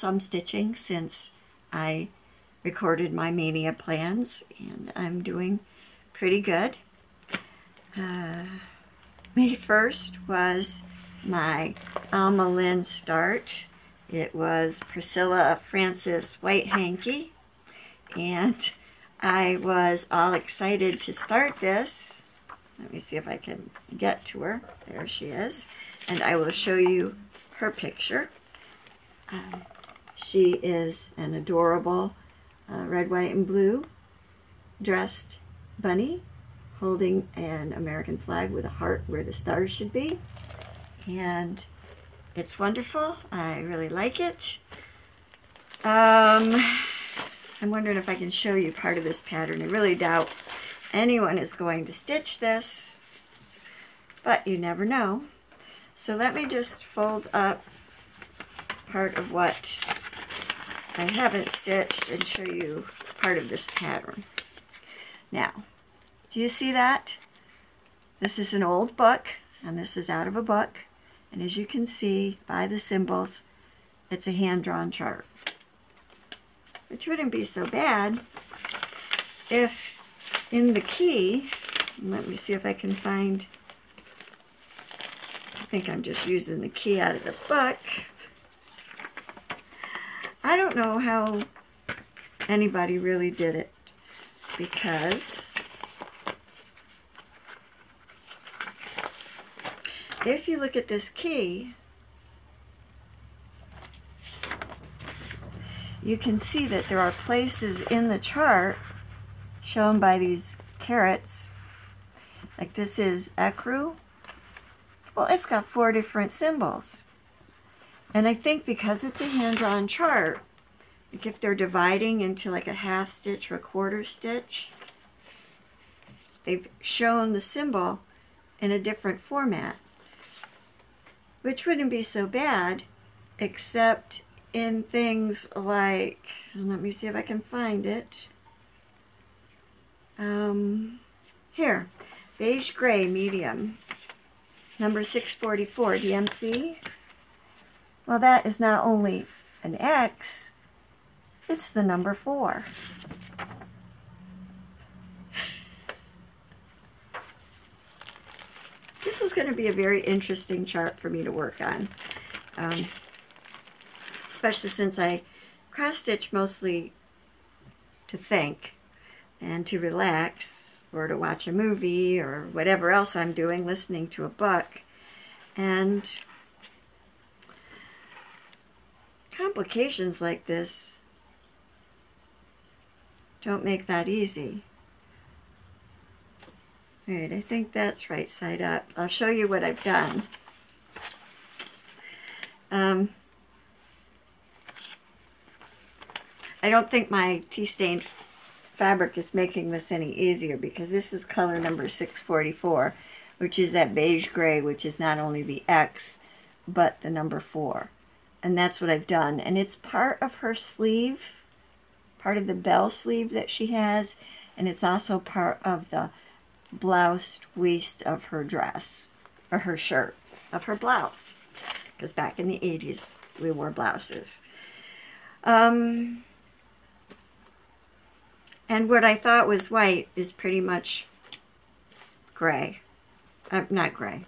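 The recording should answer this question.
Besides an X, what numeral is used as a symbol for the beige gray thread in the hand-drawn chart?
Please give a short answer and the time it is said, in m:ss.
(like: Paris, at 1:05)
4, at 2:31.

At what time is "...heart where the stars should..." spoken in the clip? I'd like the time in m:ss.
0:38.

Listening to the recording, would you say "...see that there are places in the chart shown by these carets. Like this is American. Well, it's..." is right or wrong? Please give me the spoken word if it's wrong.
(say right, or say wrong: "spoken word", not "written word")
wrong: "Ecru", not "American".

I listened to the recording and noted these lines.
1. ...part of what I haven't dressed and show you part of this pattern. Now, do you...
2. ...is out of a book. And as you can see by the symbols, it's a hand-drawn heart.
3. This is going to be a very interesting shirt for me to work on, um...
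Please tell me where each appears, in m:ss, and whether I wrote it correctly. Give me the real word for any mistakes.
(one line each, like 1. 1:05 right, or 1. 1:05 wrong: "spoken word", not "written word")
1. 0:58 wrong: "stitched", not "dressed"
2. 1:09 wrong: "chart", not "heart"
3. 2:39 wrong: "chart", not "shirt".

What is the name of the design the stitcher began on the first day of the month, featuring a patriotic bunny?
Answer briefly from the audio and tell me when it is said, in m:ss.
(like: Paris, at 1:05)
Priscilla Francis White Hanky, at 0:14.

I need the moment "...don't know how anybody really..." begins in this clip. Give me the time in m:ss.
1:30.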